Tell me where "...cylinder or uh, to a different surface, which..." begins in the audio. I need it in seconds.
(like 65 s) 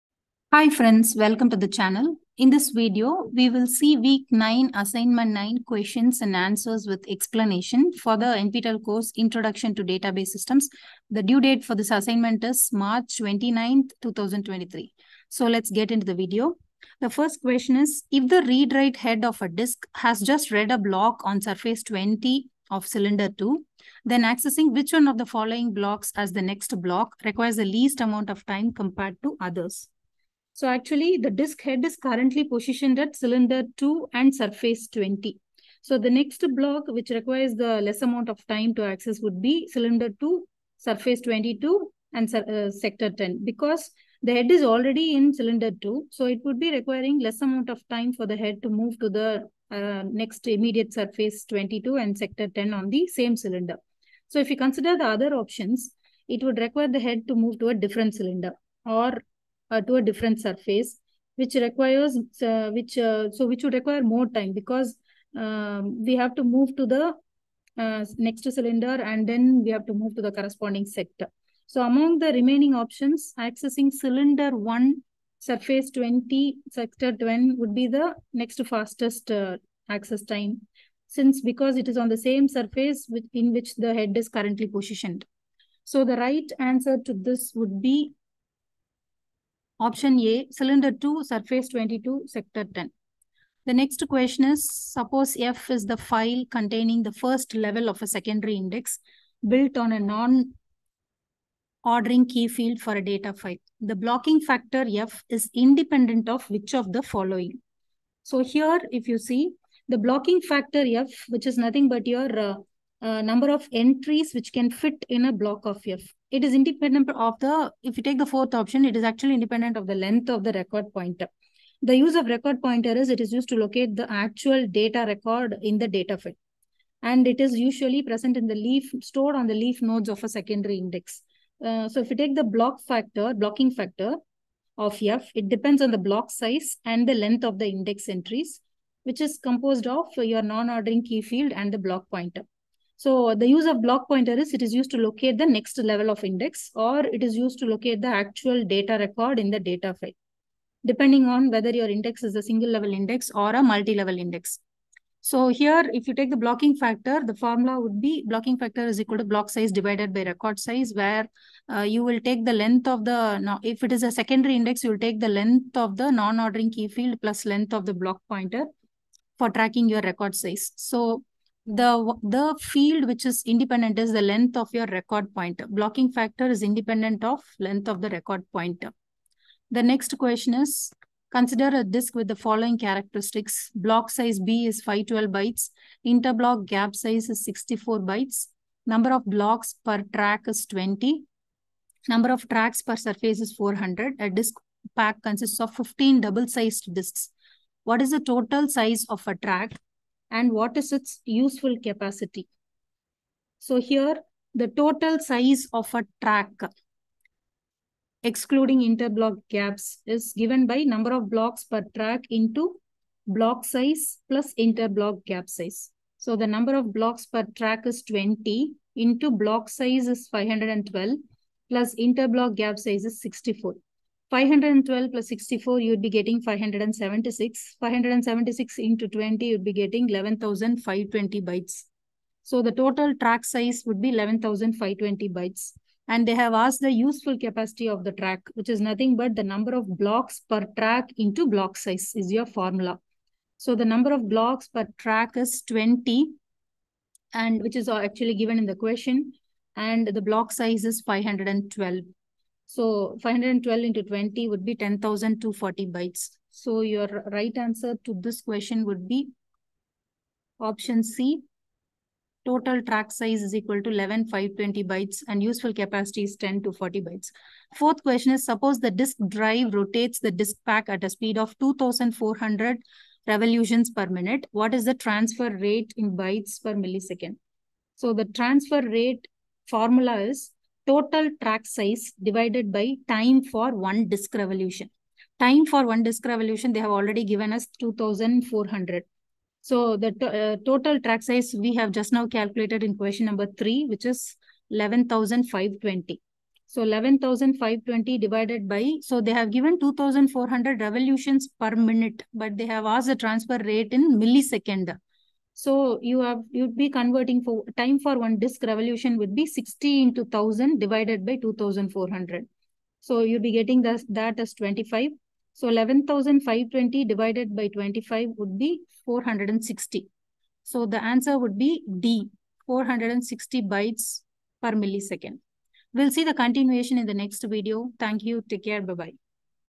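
58 s.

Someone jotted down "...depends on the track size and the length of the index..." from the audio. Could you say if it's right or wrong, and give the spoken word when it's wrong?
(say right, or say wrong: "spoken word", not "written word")
wrong: "block", not "track".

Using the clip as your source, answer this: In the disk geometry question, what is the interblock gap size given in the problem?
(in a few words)
64 bytes.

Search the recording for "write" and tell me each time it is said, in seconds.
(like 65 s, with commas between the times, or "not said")
18 s.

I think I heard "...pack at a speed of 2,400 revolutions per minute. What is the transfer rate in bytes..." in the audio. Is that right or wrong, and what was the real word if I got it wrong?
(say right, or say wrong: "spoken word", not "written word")
right.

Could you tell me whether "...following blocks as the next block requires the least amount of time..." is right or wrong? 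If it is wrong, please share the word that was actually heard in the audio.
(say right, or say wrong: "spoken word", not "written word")
right.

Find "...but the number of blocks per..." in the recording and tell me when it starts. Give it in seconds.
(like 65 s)
239 s.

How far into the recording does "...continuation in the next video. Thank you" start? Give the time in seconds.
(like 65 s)
326 s.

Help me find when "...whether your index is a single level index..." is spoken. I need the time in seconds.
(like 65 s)
151 s.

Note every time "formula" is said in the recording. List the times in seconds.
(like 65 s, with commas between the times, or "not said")
157 s, 242 s, 279 s.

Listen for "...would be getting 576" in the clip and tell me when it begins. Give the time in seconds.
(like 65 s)
225 s.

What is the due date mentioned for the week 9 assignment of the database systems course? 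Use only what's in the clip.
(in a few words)
March 29th, 2023.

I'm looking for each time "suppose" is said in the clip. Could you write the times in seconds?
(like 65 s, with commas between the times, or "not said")
94 s, 268 s.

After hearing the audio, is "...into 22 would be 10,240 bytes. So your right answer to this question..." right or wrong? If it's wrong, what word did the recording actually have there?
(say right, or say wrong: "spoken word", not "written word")
wrong: "20", not "22".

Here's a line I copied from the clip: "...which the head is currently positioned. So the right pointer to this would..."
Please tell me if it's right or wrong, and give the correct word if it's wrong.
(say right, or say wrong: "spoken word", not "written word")
wrong: "answer", not "pointer".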